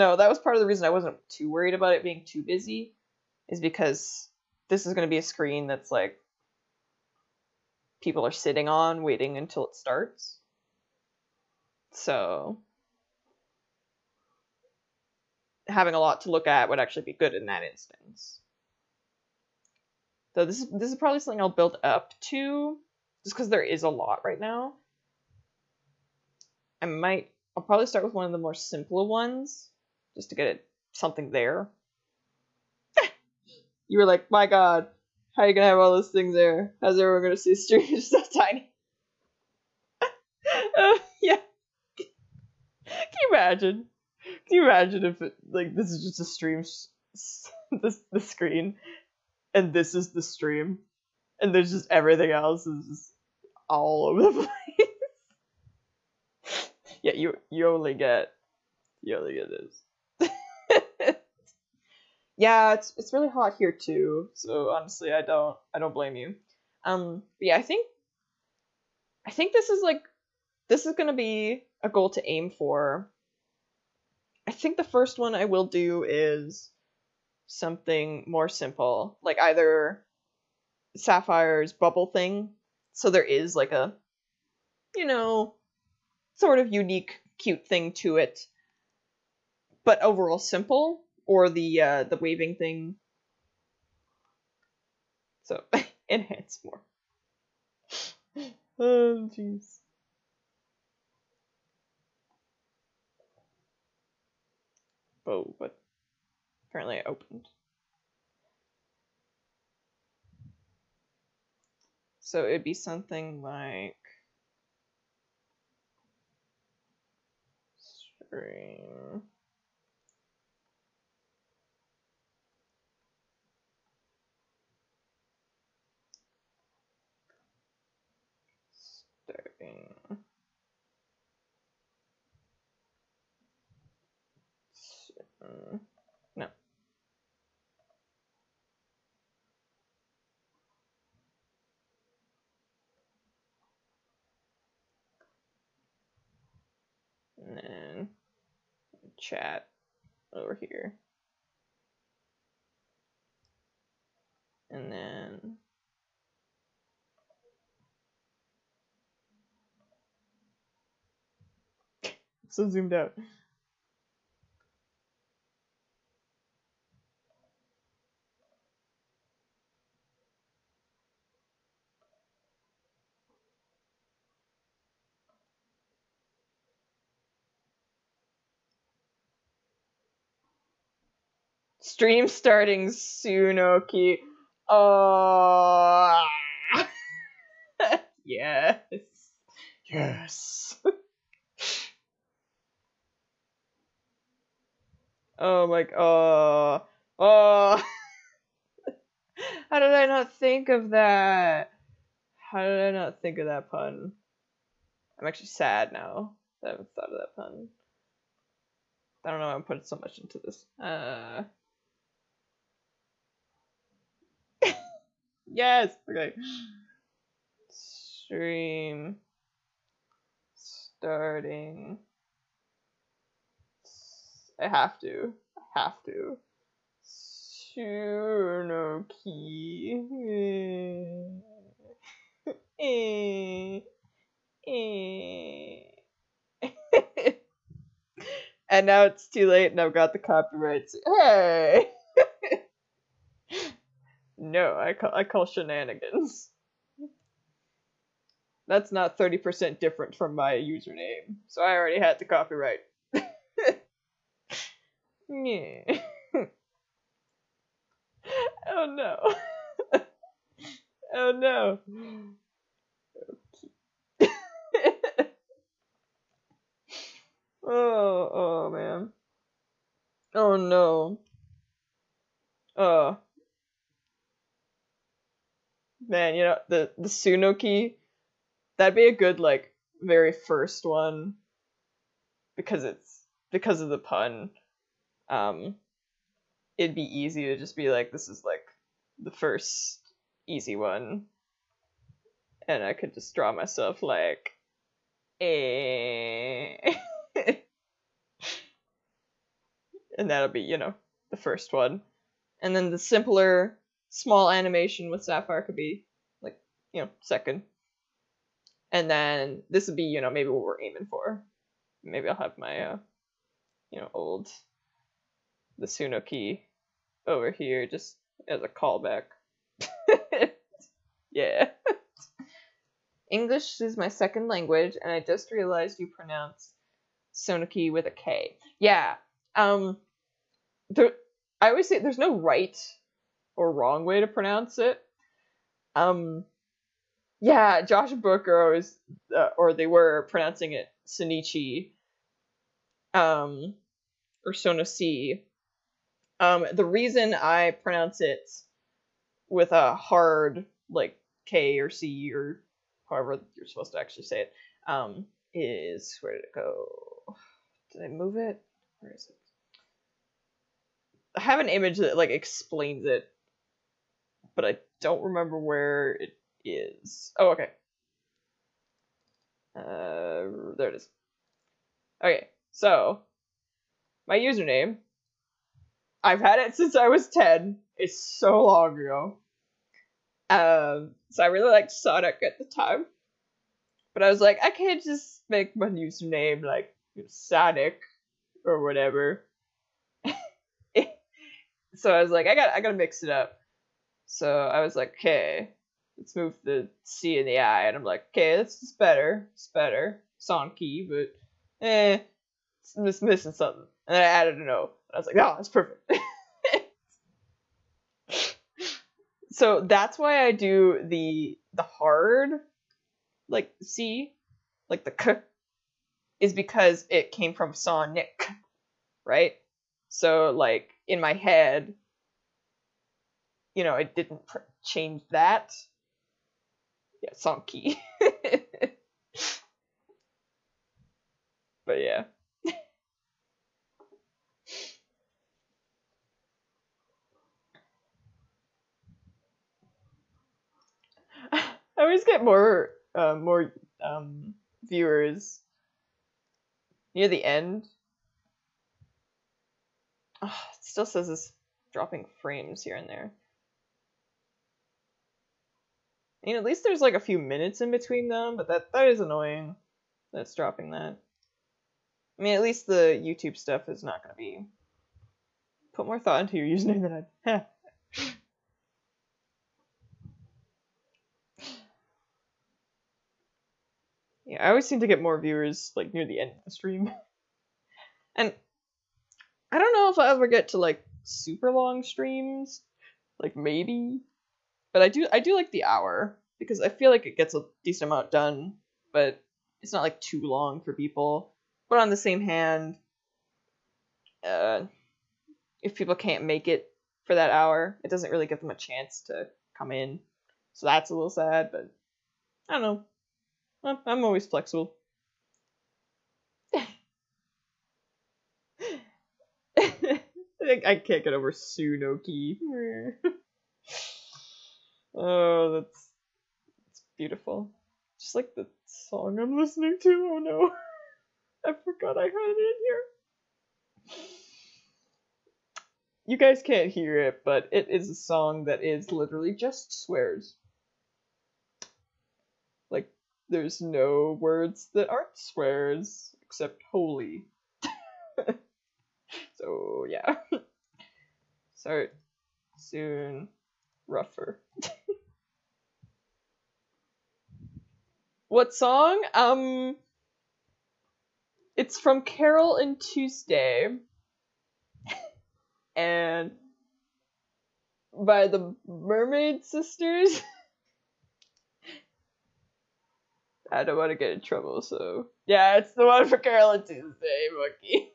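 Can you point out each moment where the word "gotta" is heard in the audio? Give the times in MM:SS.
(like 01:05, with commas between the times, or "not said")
06:32.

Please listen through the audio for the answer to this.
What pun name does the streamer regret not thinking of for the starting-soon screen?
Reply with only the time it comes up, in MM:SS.
03:47.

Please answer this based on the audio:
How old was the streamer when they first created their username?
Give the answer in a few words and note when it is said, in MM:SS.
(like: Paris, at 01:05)
10, at 06:17.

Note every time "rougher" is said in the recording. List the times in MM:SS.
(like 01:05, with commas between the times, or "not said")
09:04.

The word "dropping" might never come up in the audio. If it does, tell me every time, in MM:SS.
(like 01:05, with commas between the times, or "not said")
07:31, 07:40.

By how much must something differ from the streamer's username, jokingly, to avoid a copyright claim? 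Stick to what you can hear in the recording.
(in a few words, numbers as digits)
30%.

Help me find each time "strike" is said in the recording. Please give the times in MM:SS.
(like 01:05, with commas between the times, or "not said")
not said.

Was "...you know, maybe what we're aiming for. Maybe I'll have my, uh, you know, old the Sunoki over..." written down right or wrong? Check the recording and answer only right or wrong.
right.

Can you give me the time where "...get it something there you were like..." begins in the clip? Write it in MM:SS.
00:30.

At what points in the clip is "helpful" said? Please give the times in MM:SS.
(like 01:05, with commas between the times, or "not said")
not said.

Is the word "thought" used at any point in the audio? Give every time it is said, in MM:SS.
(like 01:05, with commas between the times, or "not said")
03:26, 07:46.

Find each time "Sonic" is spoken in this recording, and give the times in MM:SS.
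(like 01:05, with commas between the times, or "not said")
06:21, 06:27, 06:40, 06:57, 07:07.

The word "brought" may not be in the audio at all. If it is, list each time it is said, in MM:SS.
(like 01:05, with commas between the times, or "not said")
not said.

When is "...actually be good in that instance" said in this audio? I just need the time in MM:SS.
00:16.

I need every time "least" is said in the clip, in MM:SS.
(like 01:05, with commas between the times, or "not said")
07:36, 07:42.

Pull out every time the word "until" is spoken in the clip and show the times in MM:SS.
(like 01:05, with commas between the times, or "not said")
00:09.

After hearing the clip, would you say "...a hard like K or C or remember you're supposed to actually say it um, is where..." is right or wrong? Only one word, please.
wrong.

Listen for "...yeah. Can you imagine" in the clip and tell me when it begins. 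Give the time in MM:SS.
00:41.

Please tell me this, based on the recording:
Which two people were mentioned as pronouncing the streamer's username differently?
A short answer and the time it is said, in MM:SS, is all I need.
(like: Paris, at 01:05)
Josh and Booker, at 05:37.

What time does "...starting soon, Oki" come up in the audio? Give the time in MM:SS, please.
03:02.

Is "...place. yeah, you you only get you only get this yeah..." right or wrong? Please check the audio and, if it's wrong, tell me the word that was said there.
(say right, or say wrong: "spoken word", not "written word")
right.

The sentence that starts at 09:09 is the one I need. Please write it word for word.
Um, it's from Carole and Tuesday.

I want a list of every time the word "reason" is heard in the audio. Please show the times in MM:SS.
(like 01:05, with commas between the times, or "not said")
00:00, 05:46.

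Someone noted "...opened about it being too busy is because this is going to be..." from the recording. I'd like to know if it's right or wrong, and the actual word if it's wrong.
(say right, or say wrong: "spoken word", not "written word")
wrong: "worried", not "opened".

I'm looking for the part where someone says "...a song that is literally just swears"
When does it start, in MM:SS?
08:48.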